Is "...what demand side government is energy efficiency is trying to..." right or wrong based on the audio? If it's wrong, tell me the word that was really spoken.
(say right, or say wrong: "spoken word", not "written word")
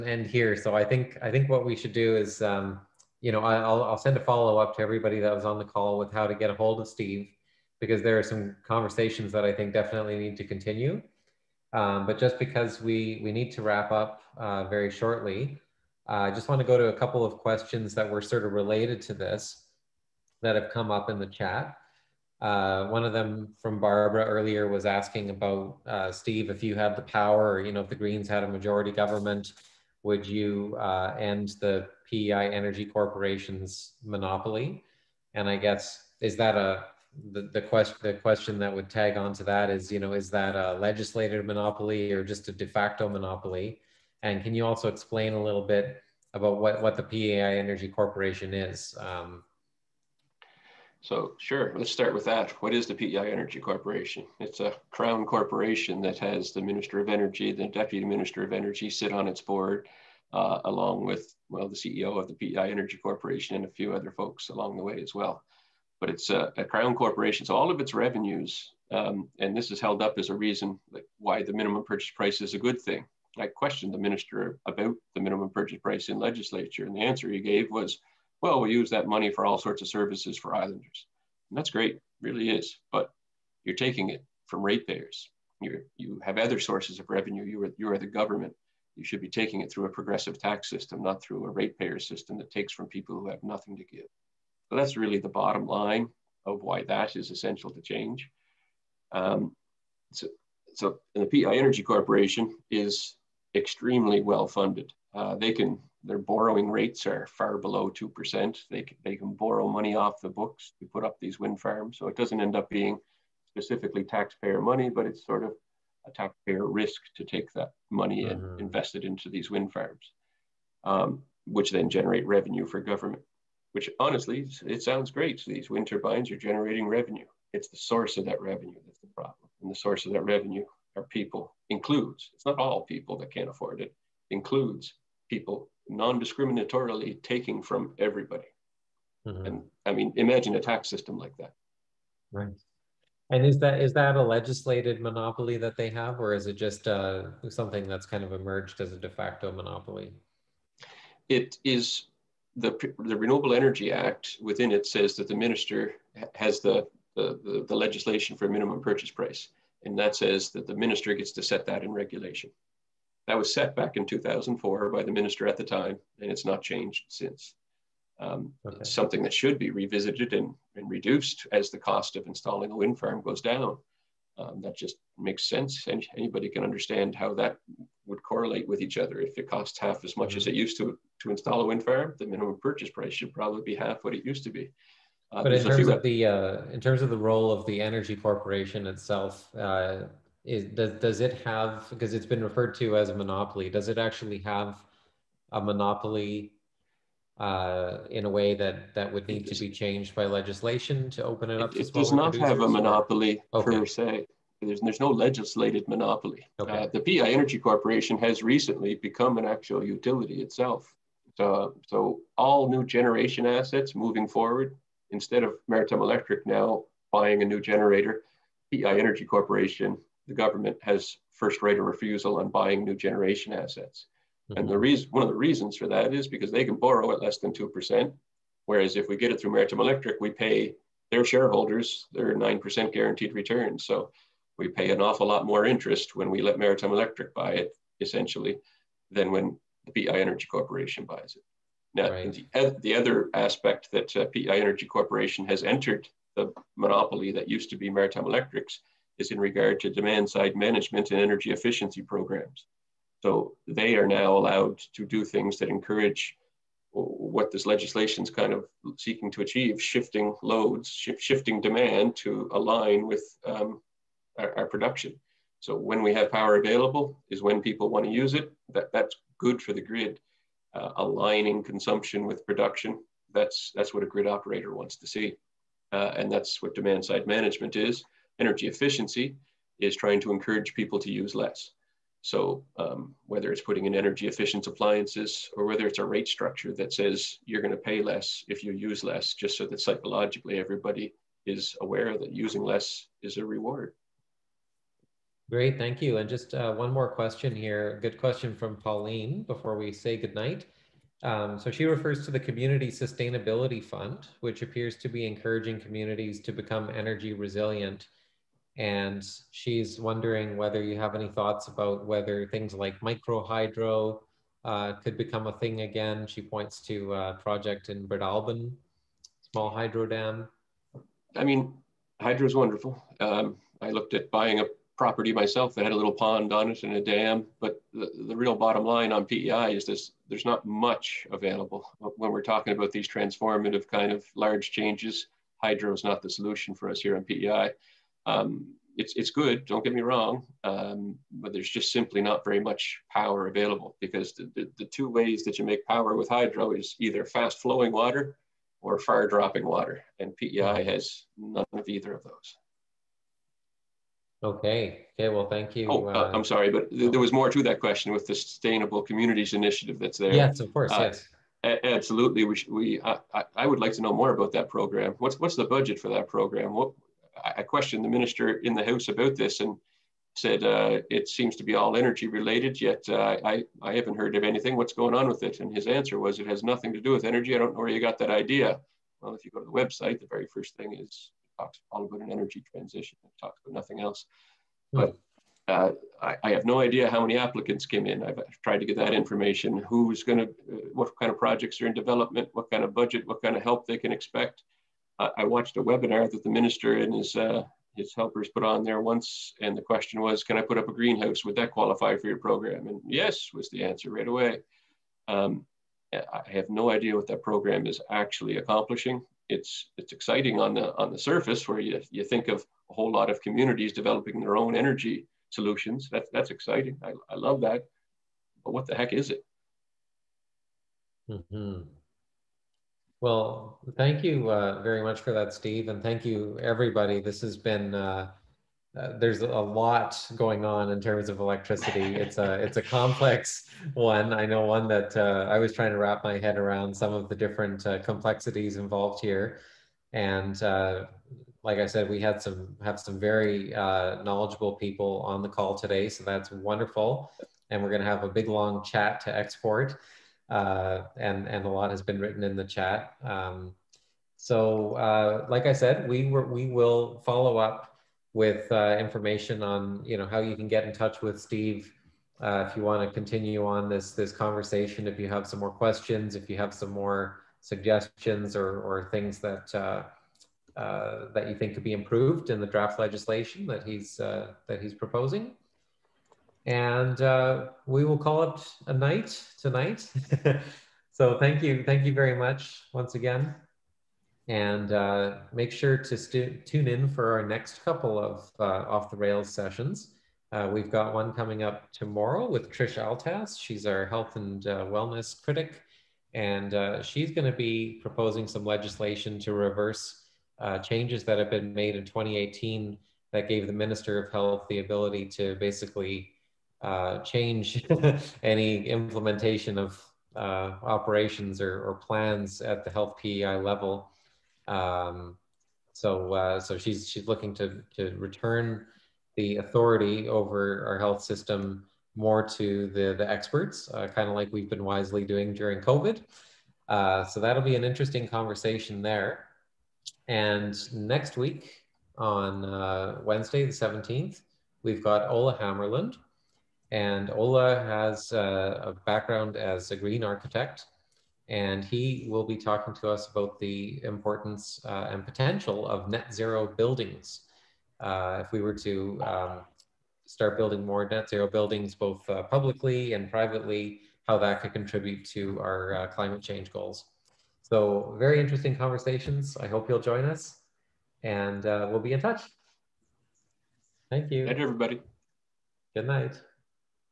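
wrong: "management", not "government".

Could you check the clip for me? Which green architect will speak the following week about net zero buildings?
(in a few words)
Ole Hammarlund.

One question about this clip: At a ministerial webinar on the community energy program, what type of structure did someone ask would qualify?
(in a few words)
greenhouse.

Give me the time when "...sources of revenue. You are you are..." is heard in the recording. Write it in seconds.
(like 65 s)
86 s.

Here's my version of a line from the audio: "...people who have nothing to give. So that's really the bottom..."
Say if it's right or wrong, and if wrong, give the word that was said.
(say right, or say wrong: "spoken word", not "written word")
right.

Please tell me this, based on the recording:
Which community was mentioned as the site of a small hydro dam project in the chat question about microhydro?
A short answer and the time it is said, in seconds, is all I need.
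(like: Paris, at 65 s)
Breadalbane, at 318 s.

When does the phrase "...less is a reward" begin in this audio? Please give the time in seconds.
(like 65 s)
292 s.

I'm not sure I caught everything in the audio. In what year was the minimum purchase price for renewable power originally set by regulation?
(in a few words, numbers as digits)
2004.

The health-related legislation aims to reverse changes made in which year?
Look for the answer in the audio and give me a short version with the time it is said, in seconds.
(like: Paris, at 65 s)
2018, at 502 s.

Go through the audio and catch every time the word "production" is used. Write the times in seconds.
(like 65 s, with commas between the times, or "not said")
264 s, 272 s.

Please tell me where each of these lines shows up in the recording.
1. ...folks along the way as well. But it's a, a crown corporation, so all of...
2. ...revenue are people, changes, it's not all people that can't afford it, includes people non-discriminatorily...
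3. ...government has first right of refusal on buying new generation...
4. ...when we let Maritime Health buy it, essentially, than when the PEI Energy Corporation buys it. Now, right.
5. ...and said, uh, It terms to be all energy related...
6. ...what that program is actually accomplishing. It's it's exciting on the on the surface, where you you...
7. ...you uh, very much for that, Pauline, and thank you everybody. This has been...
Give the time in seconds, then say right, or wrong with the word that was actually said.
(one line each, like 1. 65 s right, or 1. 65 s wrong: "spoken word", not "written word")
1. 64 s right
2. 130 s wrong: "includes", not "changes"
3. 220 s right
4. 236 s wrong: "Electric", not "Health"
5. 369 s wrong: "seems", not "terms"
6. 407 s right
7. 424 s wrong: "Steve", not "Pauline".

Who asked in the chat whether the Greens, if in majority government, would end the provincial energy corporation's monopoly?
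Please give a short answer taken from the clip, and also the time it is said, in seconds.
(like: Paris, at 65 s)
Barbara, at 23 s.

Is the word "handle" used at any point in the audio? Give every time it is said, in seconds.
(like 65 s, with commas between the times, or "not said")
not said.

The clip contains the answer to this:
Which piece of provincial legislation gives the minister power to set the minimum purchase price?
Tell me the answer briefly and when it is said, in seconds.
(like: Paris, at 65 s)
Renewable Energy Act, at 153 s.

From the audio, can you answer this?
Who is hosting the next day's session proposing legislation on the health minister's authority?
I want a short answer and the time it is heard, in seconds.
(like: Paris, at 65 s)
Trish Altass, at 492 s.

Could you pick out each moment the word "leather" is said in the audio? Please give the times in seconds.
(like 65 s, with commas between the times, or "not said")
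not said.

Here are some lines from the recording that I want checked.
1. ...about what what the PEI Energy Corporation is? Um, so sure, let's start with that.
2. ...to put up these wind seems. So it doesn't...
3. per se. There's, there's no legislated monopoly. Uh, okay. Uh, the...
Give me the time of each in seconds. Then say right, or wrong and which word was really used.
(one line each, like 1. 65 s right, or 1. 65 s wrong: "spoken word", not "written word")
1. 46 s right
2. 110 s wrong: "farms", not "seems"
3. 203 s right.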